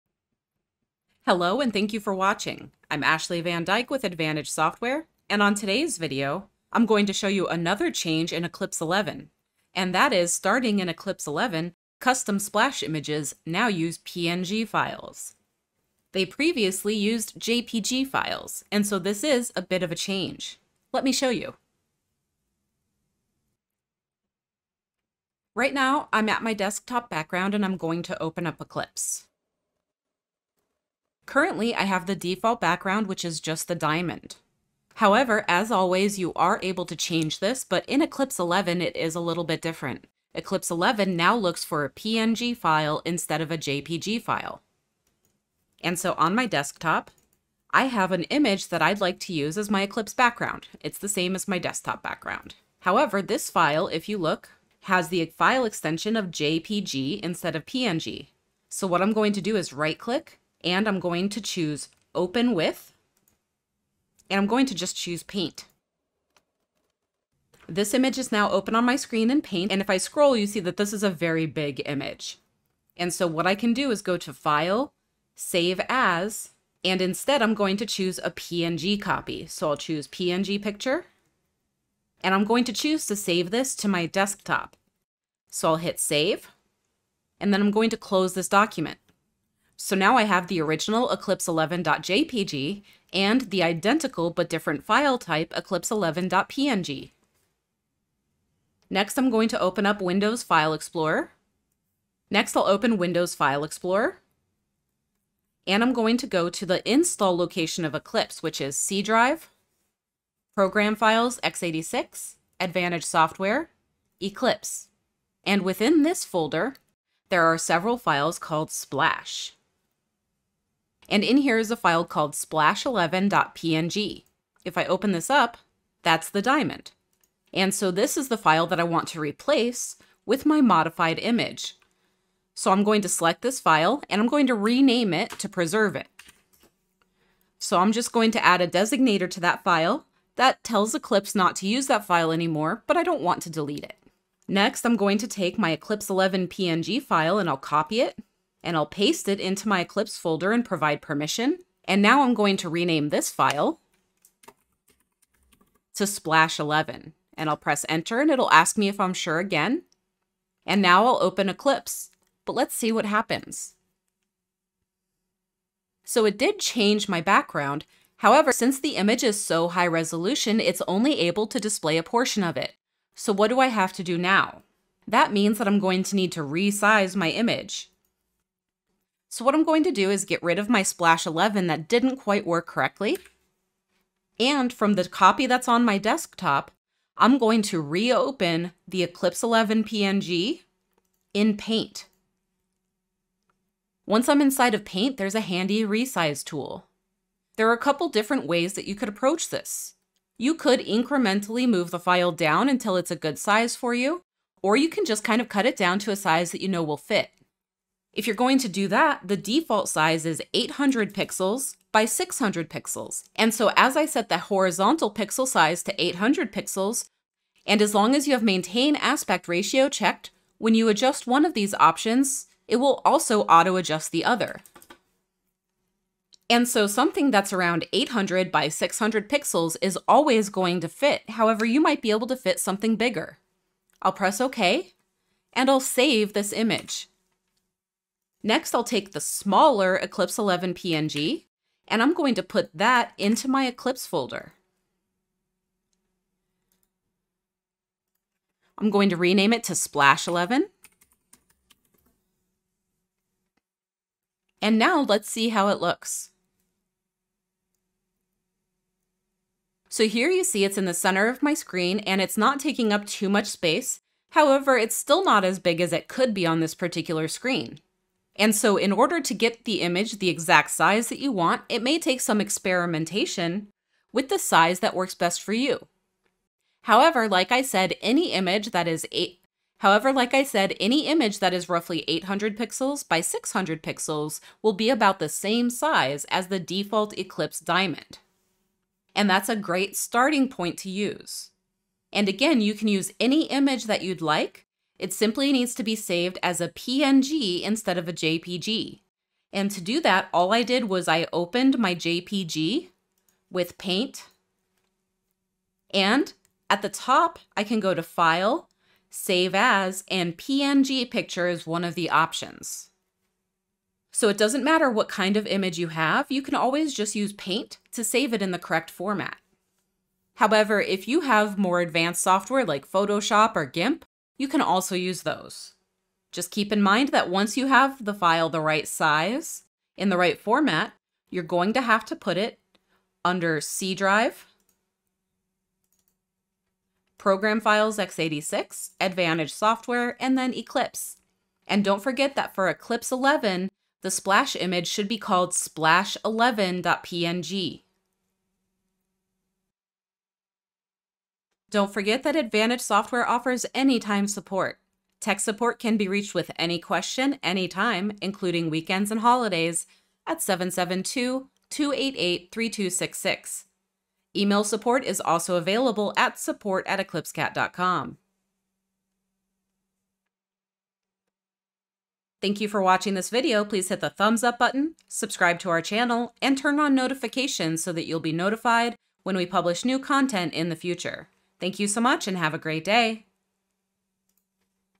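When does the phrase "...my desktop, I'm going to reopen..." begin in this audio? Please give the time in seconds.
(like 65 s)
185 s.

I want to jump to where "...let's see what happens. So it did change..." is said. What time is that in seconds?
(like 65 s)
162 s.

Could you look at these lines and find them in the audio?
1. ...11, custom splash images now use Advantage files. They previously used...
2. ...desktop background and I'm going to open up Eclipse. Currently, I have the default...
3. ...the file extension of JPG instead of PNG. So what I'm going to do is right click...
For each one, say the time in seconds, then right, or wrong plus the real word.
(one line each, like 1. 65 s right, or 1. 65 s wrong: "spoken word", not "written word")
1. 11 s wrong: "PNG", not "Advantage"
2. 26 s right
3. 55 s right.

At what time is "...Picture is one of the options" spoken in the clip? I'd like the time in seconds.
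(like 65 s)
311 s.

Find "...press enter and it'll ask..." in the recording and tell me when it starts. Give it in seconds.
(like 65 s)
157 s.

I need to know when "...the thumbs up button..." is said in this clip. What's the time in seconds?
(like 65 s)
374 s.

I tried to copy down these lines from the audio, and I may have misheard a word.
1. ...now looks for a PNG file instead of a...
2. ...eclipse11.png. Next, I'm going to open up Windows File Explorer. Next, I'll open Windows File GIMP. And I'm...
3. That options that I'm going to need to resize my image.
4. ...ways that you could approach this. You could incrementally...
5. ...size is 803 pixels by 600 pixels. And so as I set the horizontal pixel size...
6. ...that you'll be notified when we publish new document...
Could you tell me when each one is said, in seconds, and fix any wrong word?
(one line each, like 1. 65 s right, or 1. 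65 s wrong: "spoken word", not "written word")
1. 41 s right
2. 95 s wrong: "Explorer", not "GIMP"
3. 175 s wrong: "means", not "options"
4. 198 s right
5. 209 s wrong: "800", not "803"
6. 377 s wrong: "content", not "document".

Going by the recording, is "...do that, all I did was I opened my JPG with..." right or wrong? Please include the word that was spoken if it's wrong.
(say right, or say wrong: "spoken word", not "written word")
right.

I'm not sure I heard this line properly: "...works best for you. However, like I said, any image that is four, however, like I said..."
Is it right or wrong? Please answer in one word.
wrong.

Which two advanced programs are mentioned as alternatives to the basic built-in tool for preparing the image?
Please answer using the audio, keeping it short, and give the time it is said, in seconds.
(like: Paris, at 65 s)
Photoshop or GIMP, at 322 s.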